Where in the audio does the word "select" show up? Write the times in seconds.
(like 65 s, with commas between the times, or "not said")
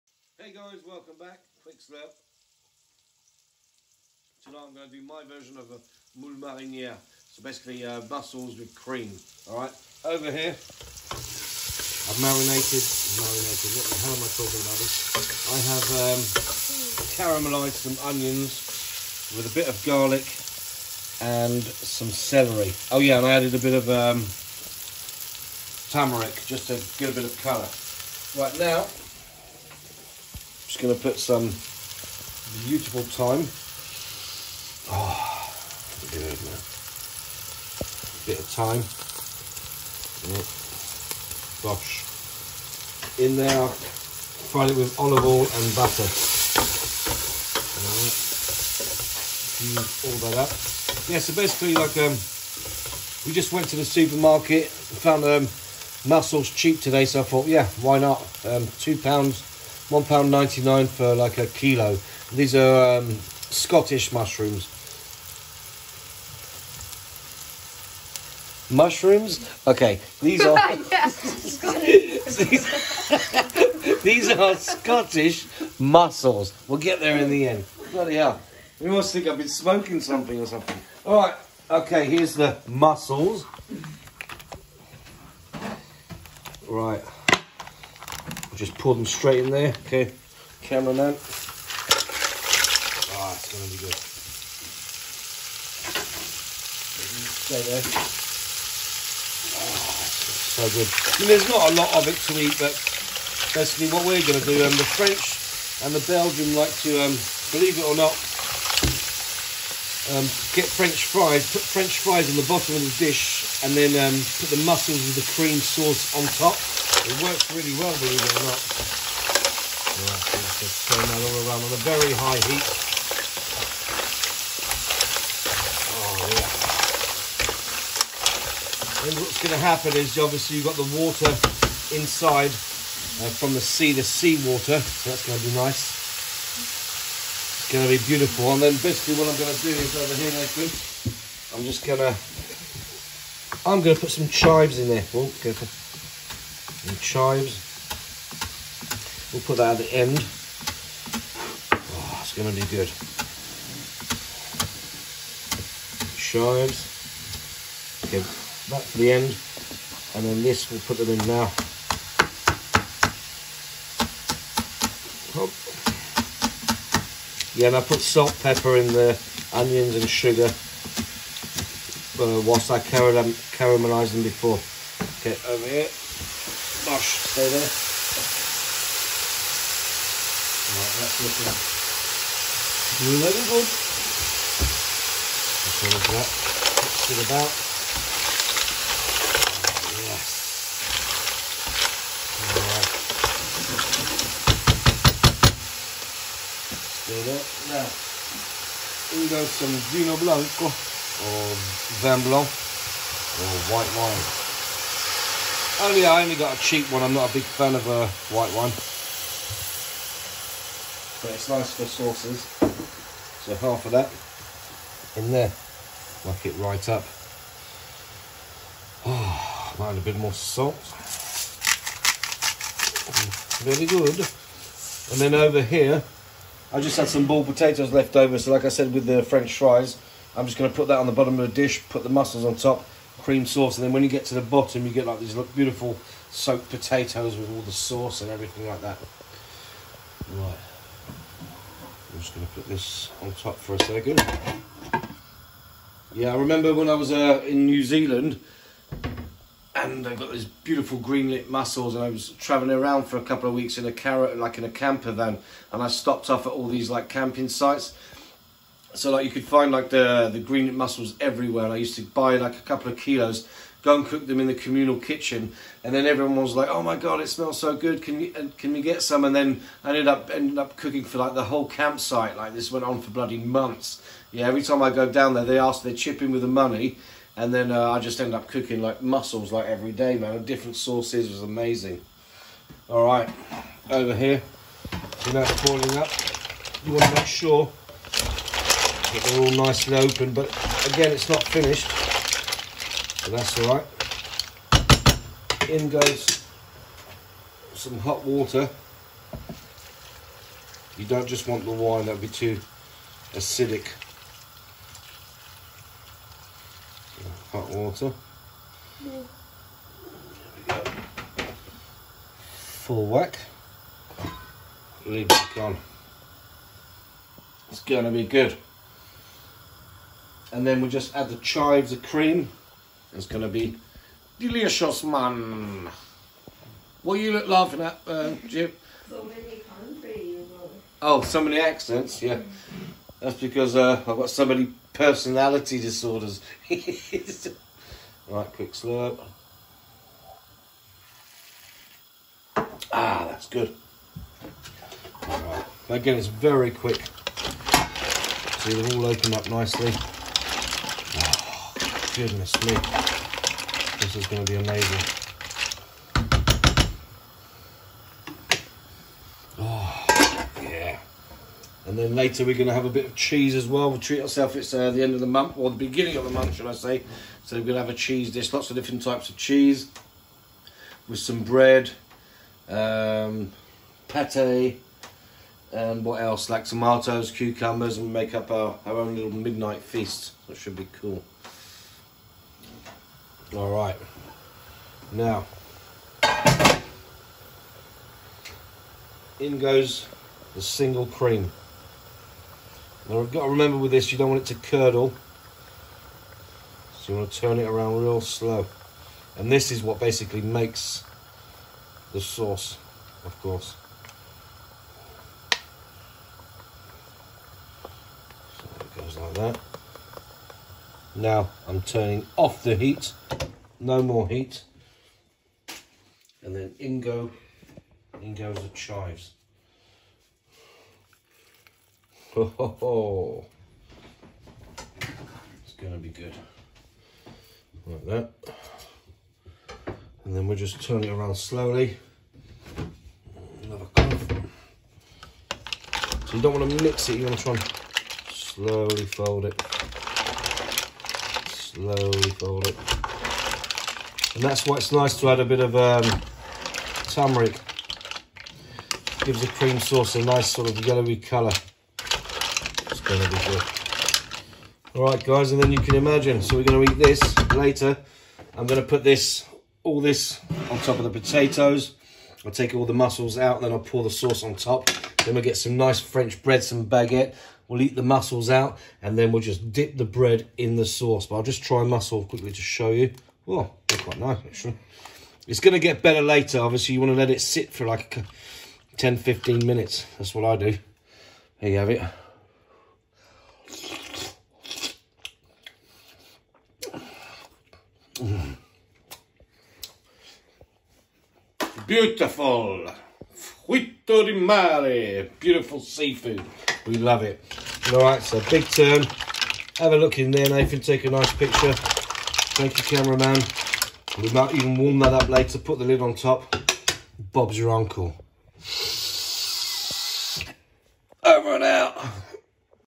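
not said.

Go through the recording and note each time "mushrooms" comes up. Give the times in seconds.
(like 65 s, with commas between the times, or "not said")
64 s, 68 s.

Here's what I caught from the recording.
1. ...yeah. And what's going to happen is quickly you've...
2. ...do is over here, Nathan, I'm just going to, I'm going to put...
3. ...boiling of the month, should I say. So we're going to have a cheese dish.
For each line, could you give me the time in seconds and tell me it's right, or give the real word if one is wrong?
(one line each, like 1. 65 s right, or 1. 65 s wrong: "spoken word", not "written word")
1. 126 s wrong: "obviously", not "quickly"
2. 139 s right
3. 365 s wrong: "beginning", not "boiling".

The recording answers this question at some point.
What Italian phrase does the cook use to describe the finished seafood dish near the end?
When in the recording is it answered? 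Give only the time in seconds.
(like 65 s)
493 s.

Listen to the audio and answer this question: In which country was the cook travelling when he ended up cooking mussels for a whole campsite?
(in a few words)
New Zealand.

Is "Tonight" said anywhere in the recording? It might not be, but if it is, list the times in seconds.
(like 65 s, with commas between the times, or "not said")
4 s.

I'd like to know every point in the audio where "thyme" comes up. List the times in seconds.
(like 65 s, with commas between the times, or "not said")
33 s, 38 s.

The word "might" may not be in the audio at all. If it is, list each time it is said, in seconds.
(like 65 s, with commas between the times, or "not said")
219 s, 504 s.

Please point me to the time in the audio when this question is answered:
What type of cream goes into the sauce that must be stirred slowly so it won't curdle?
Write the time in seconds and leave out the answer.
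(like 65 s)
390 s.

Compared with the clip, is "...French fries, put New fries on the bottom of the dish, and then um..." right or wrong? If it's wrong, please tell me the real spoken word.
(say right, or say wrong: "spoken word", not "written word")
wrong: "French", not "New".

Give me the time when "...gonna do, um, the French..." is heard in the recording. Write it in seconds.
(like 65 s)
104 s.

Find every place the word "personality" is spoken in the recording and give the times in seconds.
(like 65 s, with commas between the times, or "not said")
334 s.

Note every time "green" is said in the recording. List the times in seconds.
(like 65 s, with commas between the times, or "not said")
250 s, 260 s.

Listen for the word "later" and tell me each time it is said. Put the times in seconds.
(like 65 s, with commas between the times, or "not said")
362 s, 457 s, 476 s, 505 s.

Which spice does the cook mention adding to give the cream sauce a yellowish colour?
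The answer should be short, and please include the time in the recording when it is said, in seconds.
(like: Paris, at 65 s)
turmeric, at 447 s.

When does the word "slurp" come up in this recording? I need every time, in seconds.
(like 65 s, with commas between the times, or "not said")
1 s, 338 s.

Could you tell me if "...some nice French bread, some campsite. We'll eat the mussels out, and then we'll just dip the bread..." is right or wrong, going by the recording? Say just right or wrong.
wrong.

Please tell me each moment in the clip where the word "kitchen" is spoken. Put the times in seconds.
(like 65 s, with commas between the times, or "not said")
264 s.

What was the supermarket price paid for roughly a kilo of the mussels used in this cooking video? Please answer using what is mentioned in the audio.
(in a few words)
£1.99.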